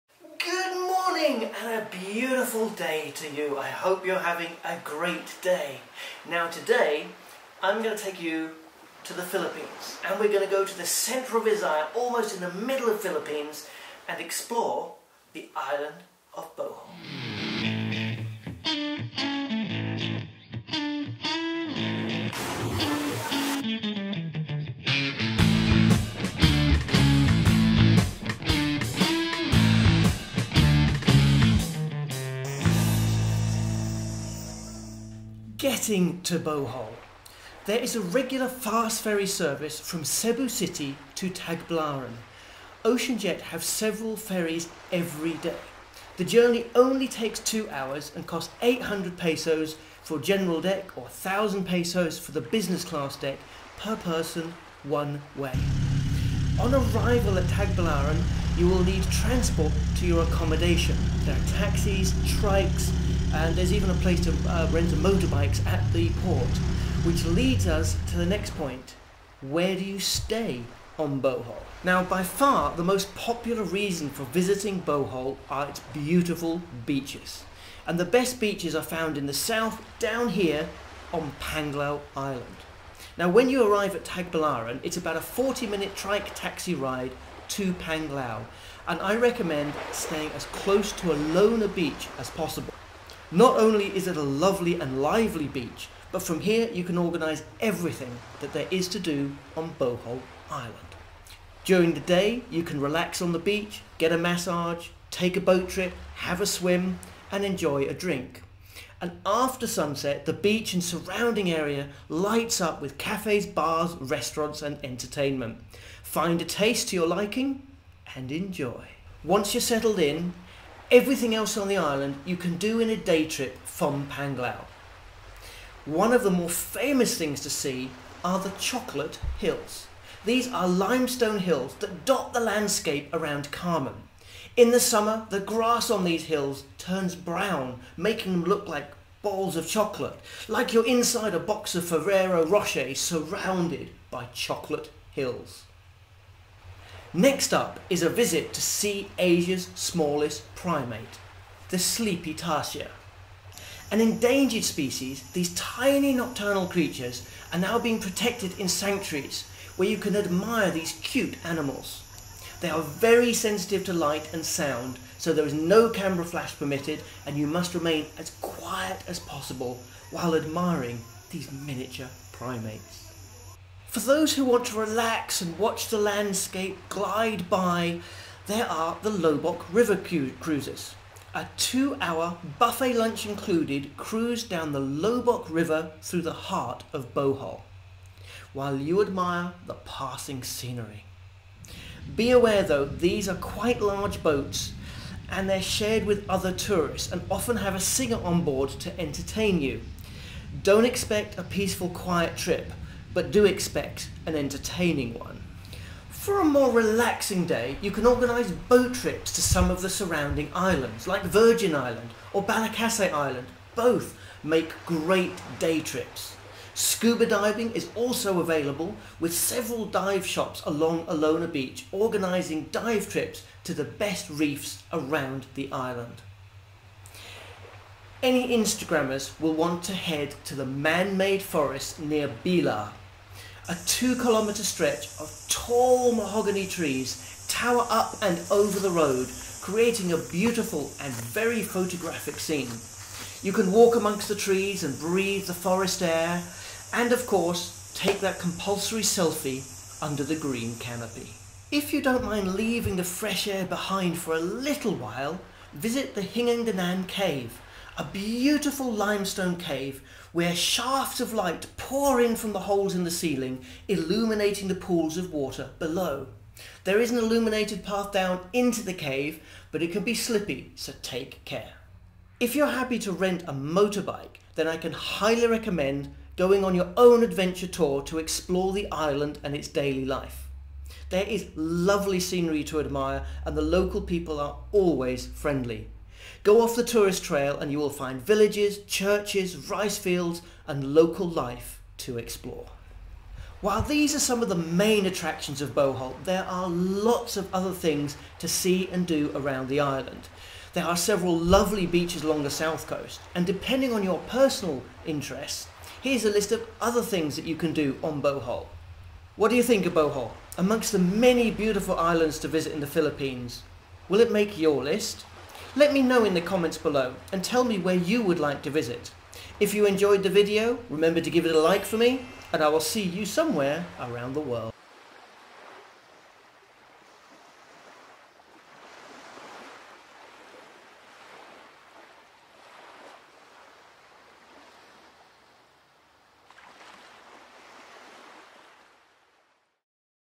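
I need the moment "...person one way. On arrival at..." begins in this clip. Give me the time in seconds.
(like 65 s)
53 s.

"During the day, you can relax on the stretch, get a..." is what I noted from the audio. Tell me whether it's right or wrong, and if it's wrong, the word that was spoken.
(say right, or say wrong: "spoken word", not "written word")
wrong: "beach", not "stretch".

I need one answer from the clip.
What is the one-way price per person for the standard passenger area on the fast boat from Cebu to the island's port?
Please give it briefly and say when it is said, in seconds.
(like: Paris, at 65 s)
800 pesos, at 48 s.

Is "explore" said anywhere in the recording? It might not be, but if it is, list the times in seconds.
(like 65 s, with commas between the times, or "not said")
14 s, 278 s, 292 s.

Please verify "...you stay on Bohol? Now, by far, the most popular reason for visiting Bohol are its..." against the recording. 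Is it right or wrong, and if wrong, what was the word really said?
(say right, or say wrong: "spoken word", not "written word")
right.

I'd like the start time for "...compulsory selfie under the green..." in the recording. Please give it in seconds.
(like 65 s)
248 s.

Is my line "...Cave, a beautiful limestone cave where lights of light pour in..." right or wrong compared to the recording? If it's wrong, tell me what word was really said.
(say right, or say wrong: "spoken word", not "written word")
wrong: "shafts", not "lights".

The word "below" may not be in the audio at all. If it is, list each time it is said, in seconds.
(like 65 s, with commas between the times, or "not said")
265 s, 316 s.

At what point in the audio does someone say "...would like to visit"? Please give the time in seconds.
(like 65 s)
318 s.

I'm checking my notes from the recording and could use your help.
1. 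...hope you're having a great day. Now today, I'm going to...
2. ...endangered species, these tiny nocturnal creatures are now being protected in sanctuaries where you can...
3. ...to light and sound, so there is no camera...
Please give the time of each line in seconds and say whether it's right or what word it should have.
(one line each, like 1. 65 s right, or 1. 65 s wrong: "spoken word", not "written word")
1. 3 s right
2. 153 s right
3. 163 s right.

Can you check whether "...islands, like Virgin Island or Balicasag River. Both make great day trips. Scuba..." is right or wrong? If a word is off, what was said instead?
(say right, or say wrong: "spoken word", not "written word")
wrong: "Island", not "River".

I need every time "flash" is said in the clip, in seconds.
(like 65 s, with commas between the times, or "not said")
166 s.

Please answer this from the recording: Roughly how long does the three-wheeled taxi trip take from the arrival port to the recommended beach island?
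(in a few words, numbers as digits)
40 minutes.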